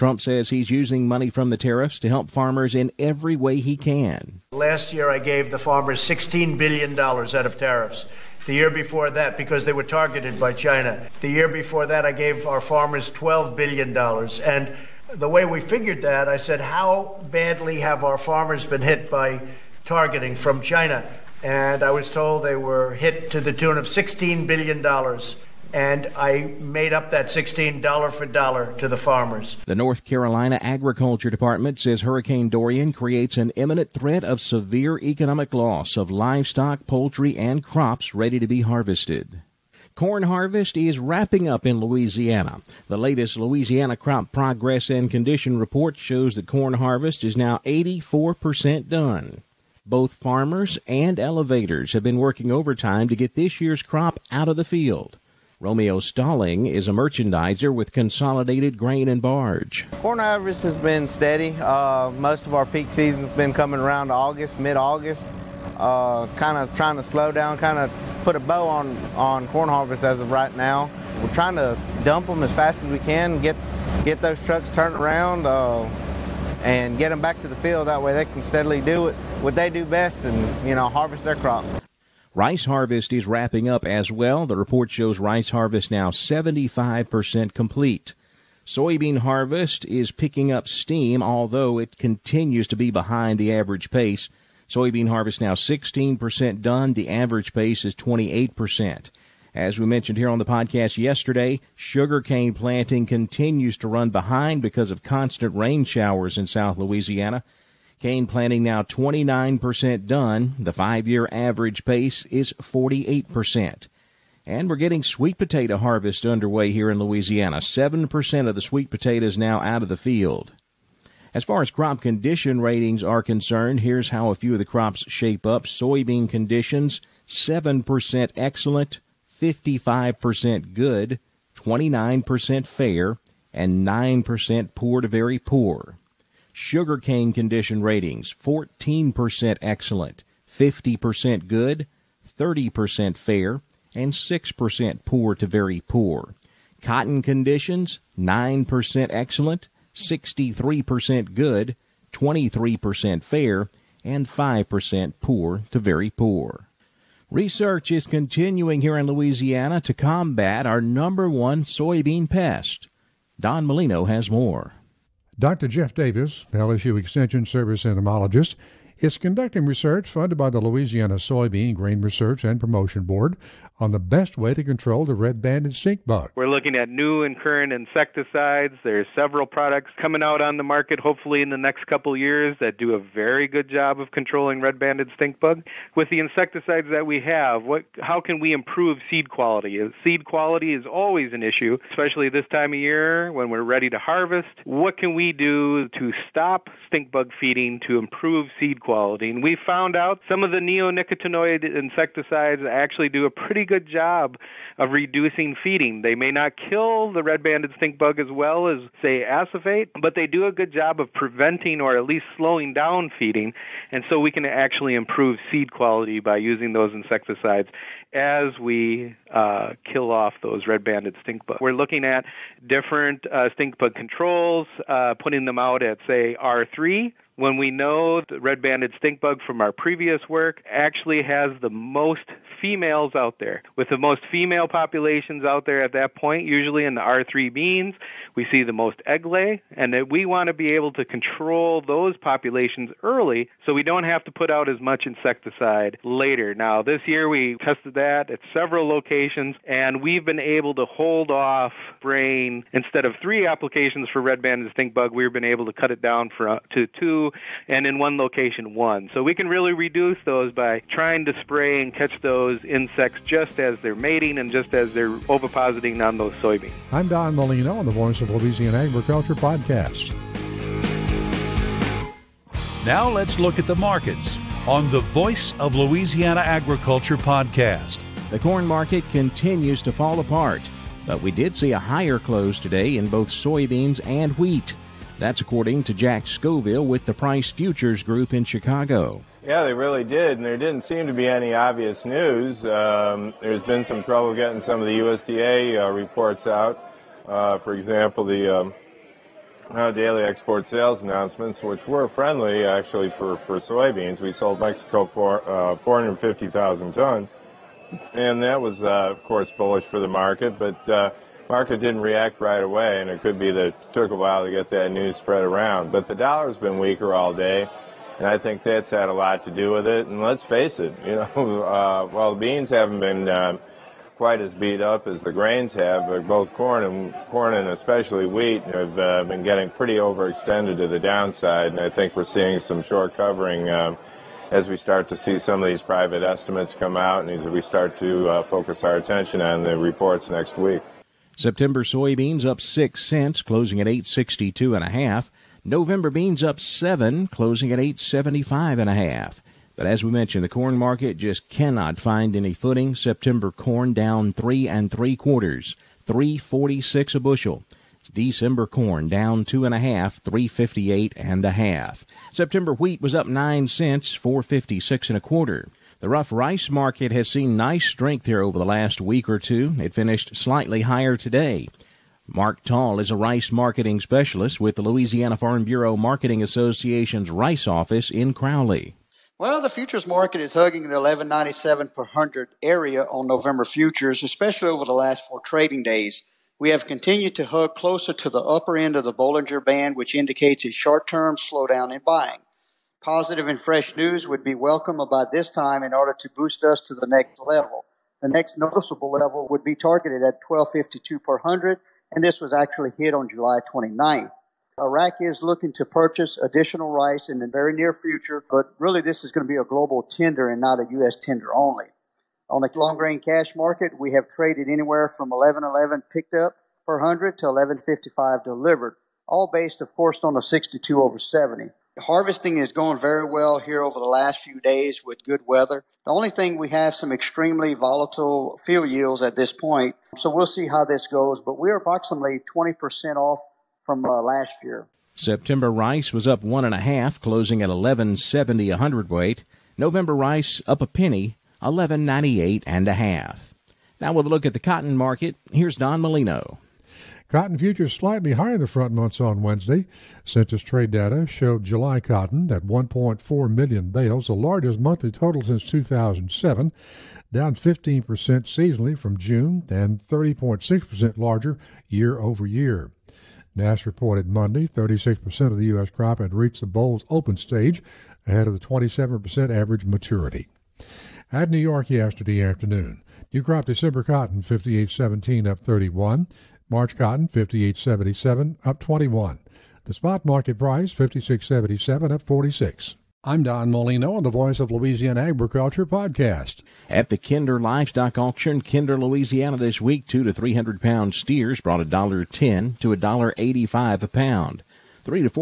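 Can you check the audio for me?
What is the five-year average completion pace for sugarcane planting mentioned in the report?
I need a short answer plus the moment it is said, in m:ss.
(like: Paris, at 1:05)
48%, at 1:52.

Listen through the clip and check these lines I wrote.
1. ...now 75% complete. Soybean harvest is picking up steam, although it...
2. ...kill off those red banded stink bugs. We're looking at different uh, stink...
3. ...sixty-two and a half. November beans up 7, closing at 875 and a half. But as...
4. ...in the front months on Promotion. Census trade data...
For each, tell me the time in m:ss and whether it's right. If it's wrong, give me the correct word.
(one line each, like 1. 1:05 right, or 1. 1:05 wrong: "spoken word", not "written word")
1. 1:25 right
2. 3:39 right
3. 5:44 right
4. 7:28 wrong: "Wednesday", not "Promotion".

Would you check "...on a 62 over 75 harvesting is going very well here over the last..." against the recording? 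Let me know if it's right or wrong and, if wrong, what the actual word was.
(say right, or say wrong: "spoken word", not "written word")
wrong: "70", not "75".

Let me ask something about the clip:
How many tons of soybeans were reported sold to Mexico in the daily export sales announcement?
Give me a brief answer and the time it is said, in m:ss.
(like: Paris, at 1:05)
450,000 tons, at 5:05.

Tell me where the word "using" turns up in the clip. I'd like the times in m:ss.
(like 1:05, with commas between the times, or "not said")
0:00, 3:36.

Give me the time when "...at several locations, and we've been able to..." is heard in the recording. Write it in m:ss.
4:08.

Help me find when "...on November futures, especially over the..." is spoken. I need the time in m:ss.
6:23.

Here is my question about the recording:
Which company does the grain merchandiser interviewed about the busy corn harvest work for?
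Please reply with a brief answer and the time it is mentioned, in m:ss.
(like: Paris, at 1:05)
Consolidated Grain and Barge, at 0:57.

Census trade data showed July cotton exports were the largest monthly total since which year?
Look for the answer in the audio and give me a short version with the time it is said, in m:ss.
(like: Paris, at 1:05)
2007, at 7:35.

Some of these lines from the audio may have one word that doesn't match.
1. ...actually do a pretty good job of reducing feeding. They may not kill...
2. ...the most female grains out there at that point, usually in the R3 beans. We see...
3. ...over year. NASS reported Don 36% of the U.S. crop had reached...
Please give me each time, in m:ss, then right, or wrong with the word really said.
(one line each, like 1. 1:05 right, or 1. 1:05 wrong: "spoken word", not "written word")
1. 3:22 right
2. 3:53 wrong: "populations", not "grains"
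3. 7:42 wrong: "Monday", not "Don".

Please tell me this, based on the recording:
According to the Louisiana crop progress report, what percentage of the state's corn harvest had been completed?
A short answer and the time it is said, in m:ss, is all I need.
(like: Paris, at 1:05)
84%, at 0:47.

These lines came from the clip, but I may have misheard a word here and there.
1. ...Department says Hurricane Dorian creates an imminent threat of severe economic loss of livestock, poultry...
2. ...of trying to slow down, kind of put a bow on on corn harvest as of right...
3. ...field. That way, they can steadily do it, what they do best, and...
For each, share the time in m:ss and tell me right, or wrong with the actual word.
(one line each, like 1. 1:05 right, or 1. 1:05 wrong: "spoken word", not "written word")
1. 0:31 right
2. 1:06 right
3. 1:17 right.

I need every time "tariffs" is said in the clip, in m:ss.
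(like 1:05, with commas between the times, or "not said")
0:01, 0:07.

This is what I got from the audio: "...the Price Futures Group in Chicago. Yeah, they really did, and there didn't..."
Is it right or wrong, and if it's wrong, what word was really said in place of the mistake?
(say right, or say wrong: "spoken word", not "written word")
right.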